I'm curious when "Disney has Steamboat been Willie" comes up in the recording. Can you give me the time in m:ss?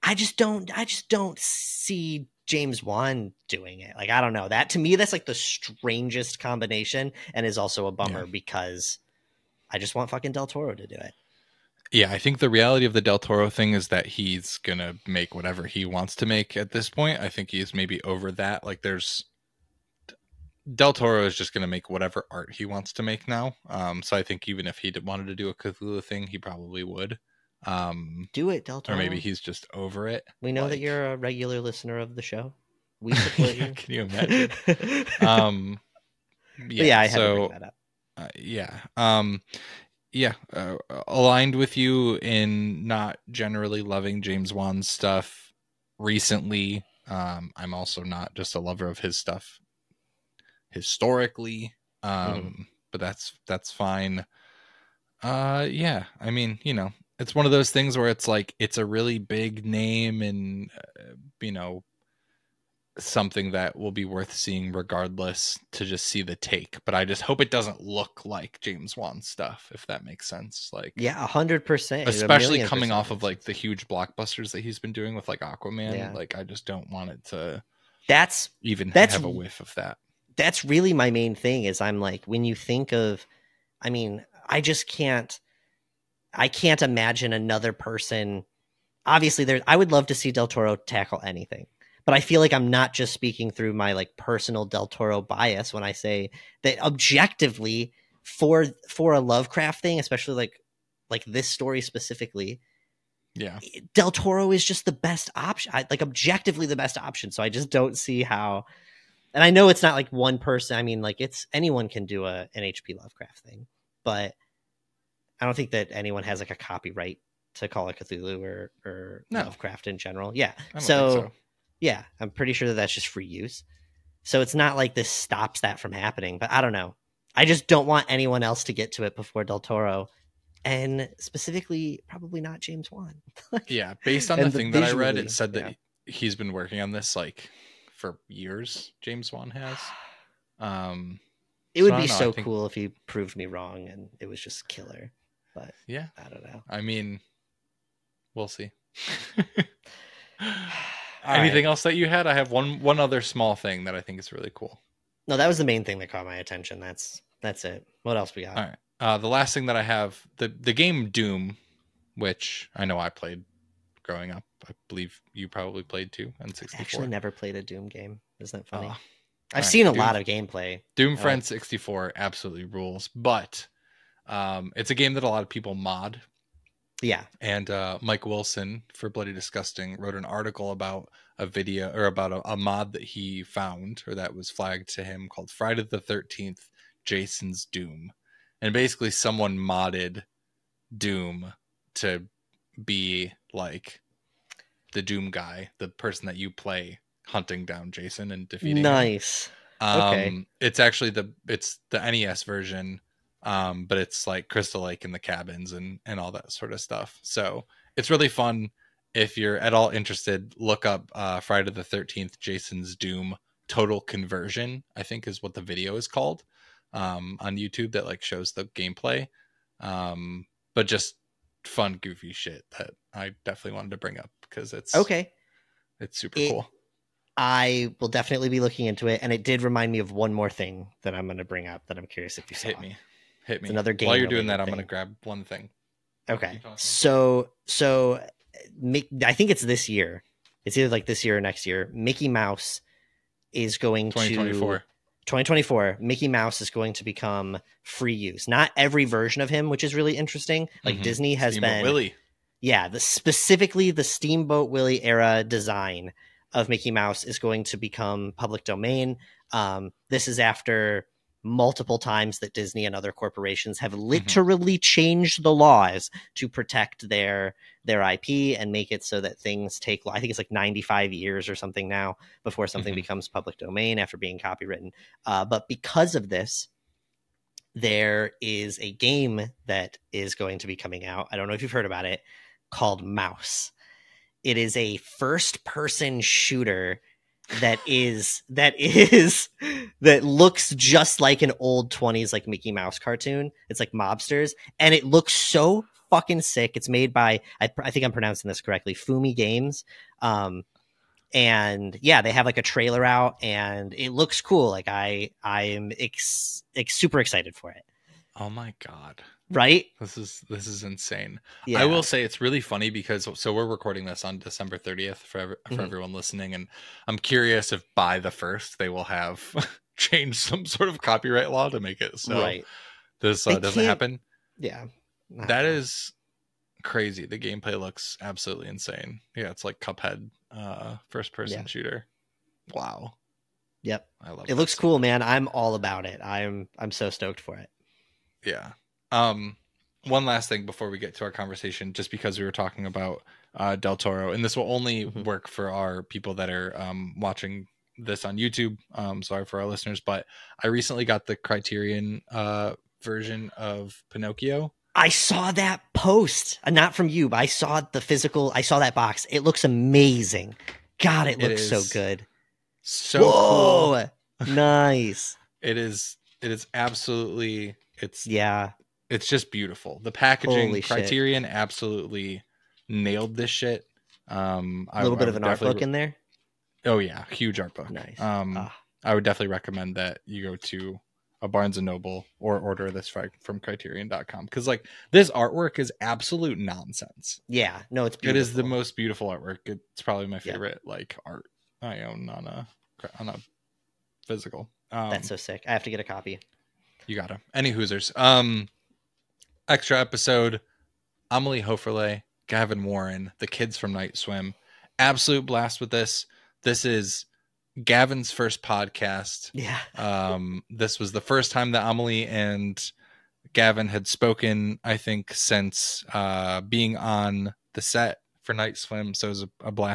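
4:11.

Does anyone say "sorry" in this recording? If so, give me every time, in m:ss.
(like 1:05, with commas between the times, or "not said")
5:49.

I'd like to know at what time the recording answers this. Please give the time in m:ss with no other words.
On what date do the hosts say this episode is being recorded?
5:14.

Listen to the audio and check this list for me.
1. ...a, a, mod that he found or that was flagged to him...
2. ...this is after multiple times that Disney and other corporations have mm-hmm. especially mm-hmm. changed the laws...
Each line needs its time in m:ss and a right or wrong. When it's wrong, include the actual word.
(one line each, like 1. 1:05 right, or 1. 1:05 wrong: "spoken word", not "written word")
1. 3:02 right
2. 4:20 wrong: "literally", not "especially".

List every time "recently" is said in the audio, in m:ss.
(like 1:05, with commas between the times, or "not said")
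0:45, 5:50.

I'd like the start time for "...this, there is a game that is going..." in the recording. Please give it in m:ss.
4:36.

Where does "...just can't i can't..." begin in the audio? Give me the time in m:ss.
1:24.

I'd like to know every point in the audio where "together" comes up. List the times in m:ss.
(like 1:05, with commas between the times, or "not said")
not said.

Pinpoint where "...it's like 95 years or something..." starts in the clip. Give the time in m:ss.
4:30.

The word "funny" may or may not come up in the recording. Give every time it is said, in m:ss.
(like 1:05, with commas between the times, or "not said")
2:48, 5:12.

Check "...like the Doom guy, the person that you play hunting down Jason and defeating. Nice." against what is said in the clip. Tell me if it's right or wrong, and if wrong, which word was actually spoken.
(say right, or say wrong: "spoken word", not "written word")
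right.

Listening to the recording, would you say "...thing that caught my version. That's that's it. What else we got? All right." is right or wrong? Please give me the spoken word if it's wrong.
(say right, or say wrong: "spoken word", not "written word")
wrong: "attention", not "version".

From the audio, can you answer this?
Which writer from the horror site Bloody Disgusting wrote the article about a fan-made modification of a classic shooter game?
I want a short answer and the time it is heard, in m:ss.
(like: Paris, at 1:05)
Mike Wilson, at 2:57.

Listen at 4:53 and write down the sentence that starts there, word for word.
It's like mobsters and it looks so fucking sick.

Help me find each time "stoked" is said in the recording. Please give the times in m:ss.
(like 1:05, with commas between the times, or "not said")
5:37.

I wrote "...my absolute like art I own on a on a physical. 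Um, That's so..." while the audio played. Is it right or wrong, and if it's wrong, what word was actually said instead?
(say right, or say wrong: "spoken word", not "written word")
wrong: "favorite", not "absolute".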